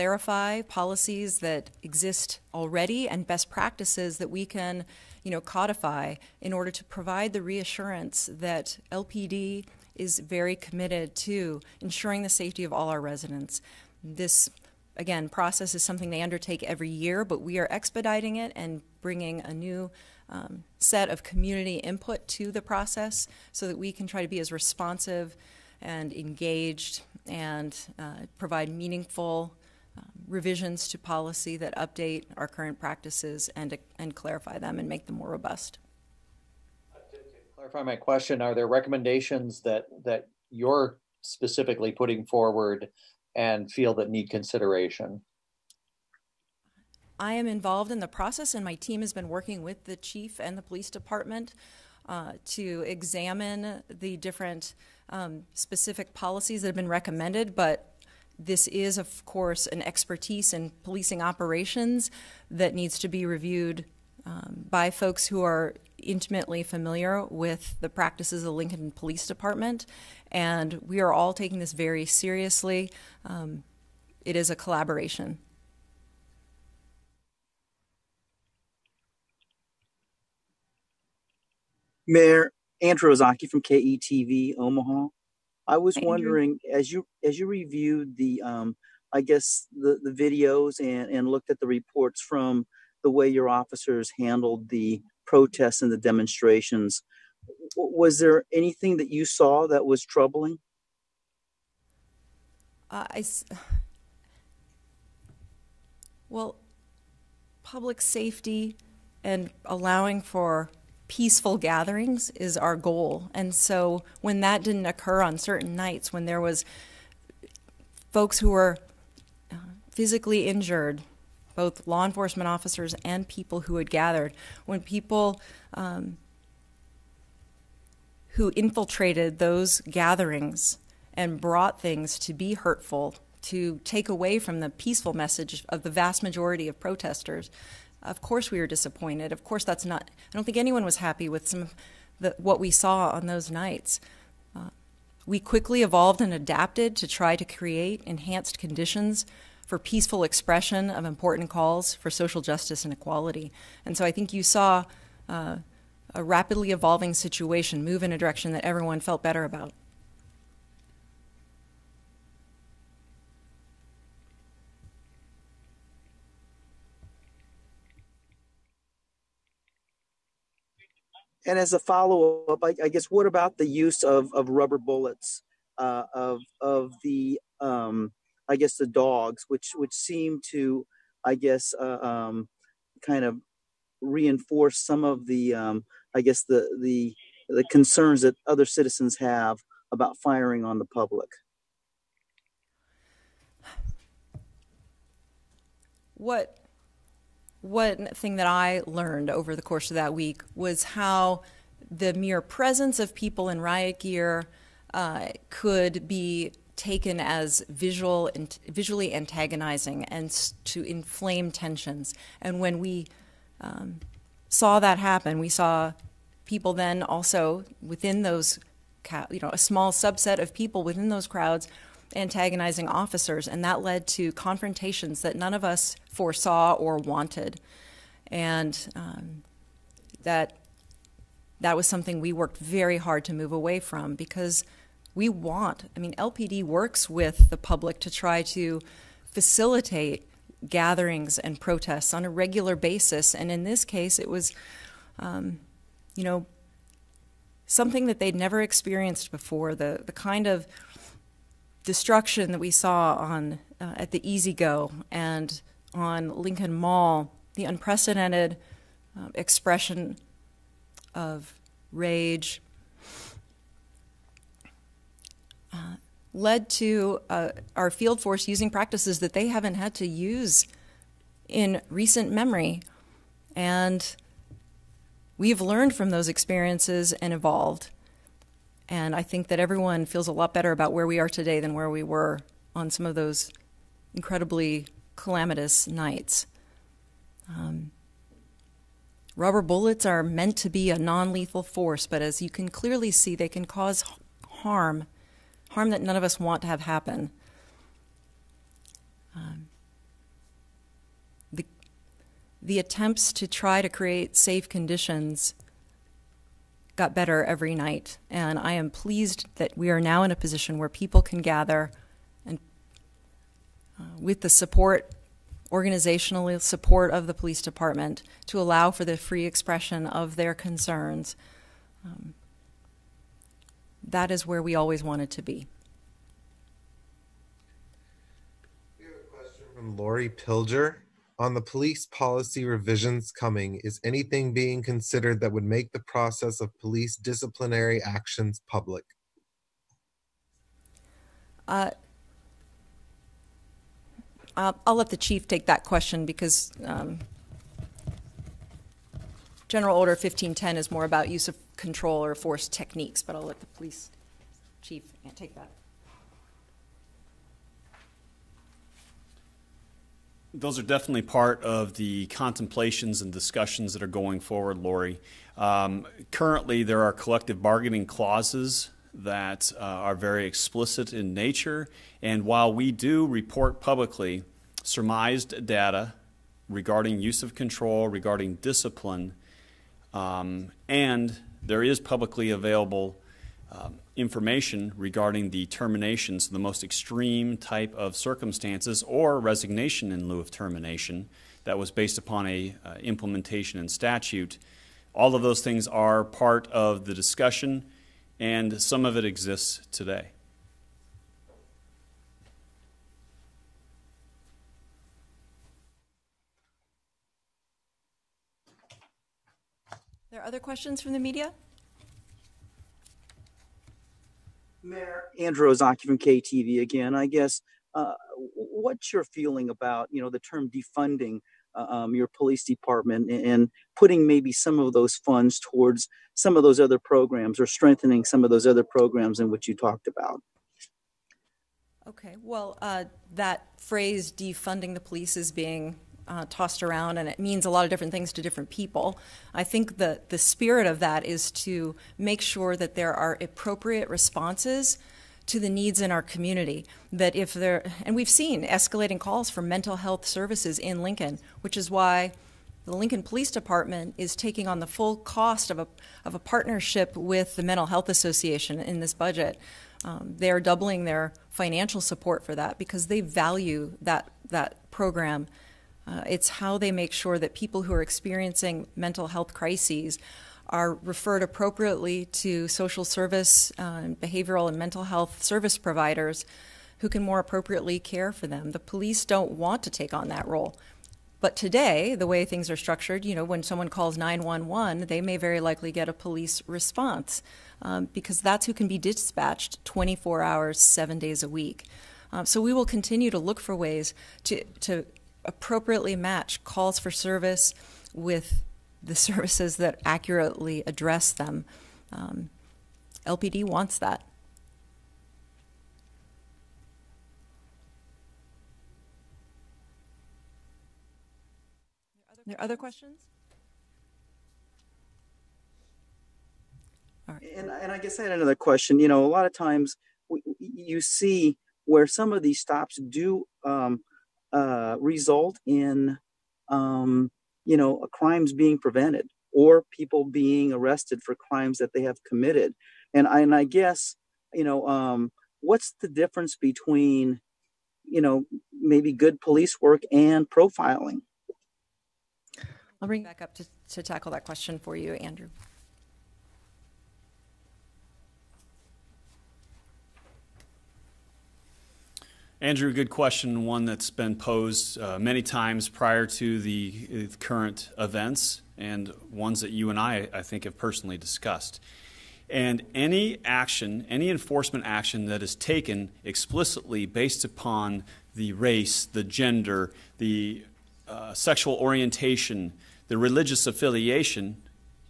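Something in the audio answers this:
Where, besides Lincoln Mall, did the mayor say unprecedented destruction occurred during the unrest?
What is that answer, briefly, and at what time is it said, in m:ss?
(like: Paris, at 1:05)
Easy Go, at 4:14.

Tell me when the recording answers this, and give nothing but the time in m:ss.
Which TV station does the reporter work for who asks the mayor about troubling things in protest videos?
1:23.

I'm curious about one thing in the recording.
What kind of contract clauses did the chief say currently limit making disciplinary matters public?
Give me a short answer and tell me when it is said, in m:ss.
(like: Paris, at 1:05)
collective bargaining, at 6:07.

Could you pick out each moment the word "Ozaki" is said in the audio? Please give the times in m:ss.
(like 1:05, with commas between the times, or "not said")
1:23, 6:55.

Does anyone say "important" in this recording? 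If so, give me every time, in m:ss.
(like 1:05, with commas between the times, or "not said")
2:31.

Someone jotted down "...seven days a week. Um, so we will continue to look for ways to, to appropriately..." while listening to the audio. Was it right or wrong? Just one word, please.
right.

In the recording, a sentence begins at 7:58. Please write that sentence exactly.
The police don't want to take on that role.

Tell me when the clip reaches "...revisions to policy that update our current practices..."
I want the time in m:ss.
0:30.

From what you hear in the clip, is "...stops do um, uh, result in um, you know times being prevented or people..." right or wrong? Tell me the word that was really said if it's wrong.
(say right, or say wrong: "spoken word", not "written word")
wrong: "crimes", not "times".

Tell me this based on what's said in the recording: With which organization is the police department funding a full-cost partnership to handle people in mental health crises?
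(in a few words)
Mental Health Association.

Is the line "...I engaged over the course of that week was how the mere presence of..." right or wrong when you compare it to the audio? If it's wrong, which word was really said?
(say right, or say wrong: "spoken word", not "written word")
wrong: "learned", not "engaged".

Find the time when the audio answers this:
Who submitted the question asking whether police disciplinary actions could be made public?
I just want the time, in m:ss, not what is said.
5:29.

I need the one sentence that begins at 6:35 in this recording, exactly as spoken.
All of those things are part of the discussion, and some of it exists today.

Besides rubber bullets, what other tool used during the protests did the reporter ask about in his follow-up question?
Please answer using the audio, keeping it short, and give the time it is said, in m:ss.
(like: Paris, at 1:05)
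dogs, at 2:58.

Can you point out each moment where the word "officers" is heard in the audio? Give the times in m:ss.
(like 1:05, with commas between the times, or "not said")
1:33, 2:02, 3:42.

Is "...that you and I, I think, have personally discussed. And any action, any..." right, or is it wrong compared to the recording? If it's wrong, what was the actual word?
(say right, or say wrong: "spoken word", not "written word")
right.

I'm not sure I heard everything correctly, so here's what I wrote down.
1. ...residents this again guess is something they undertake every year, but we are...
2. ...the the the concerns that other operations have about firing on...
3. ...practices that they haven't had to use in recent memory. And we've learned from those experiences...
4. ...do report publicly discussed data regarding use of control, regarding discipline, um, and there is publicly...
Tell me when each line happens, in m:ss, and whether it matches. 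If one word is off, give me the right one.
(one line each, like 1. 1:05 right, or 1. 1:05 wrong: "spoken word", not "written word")
1. 0:13 wrong: "process", not "guess"
2. 3:06 wrong: "citizens", not "operations"
3. 4:28 right
4. 6:12 wrong: "surmised", not "discussed".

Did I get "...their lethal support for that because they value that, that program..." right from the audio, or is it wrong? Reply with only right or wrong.
wrong.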